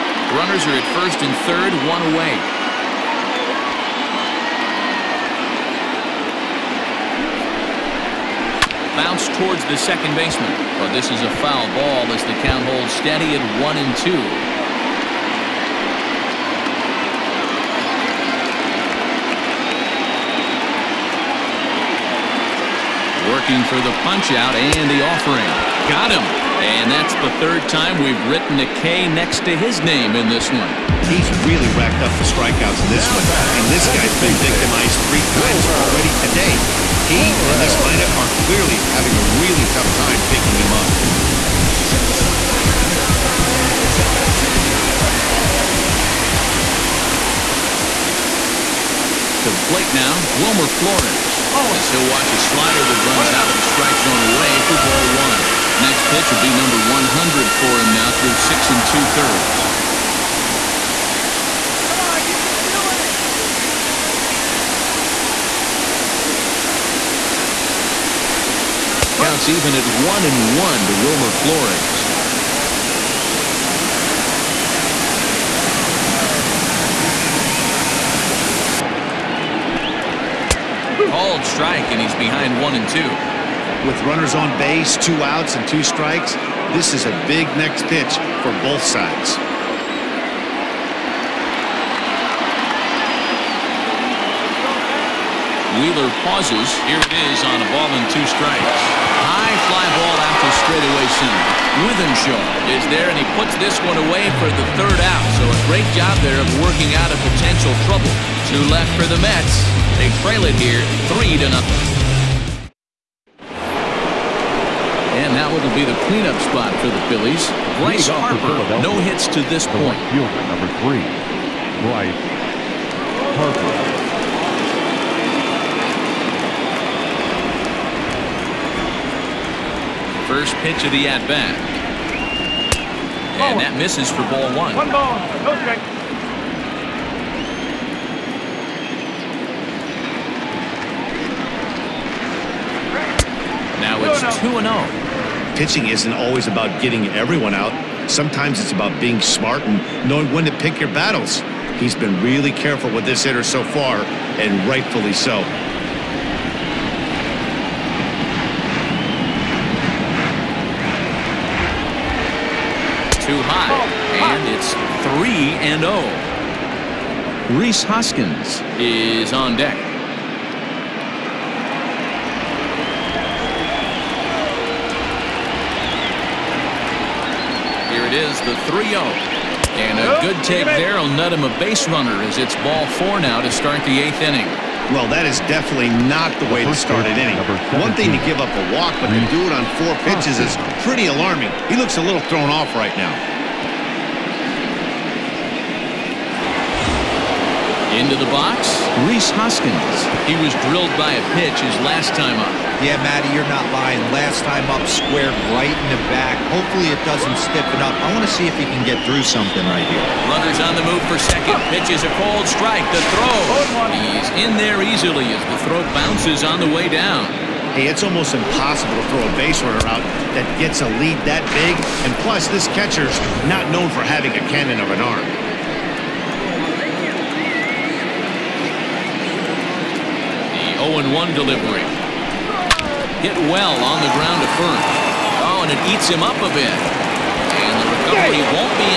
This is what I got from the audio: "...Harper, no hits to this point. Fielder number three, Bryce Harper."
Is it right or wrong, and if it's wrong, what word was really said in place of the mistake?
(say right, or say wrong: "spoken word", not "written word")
right.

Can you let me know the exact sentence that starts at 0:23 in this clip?
Working for the punchout and the offering.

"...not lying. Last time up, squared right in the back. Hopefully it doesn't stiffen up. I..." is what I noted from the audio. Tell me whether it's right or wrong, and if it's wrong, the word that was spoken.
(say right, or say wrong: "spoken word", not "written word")
right.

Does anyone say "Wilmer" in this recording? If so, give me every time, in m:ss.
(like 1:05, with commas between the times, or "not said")
0:50, 1:11.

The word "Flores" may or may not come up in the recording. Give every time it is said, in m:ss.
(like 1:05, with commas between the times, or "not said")
0:50, 1:11.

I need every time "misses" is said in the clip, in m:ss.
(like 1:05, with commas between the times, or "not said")
2:13.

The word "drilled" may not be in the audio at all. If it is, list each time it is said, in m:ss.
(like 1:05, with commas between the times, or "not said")
3:20.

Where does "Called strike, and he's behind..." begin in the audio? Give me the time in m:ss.
1:21.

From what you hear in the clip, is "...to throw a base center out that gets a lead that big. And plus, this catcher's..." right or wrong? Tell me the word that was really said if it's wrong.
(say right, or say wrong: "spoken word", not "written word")
wrong: "runner", not "center".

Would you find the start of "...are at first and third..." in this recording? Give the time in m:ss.
0:00.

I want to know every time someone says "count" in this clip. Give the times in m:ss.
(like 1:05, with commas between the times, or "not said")
0:12, 1:09.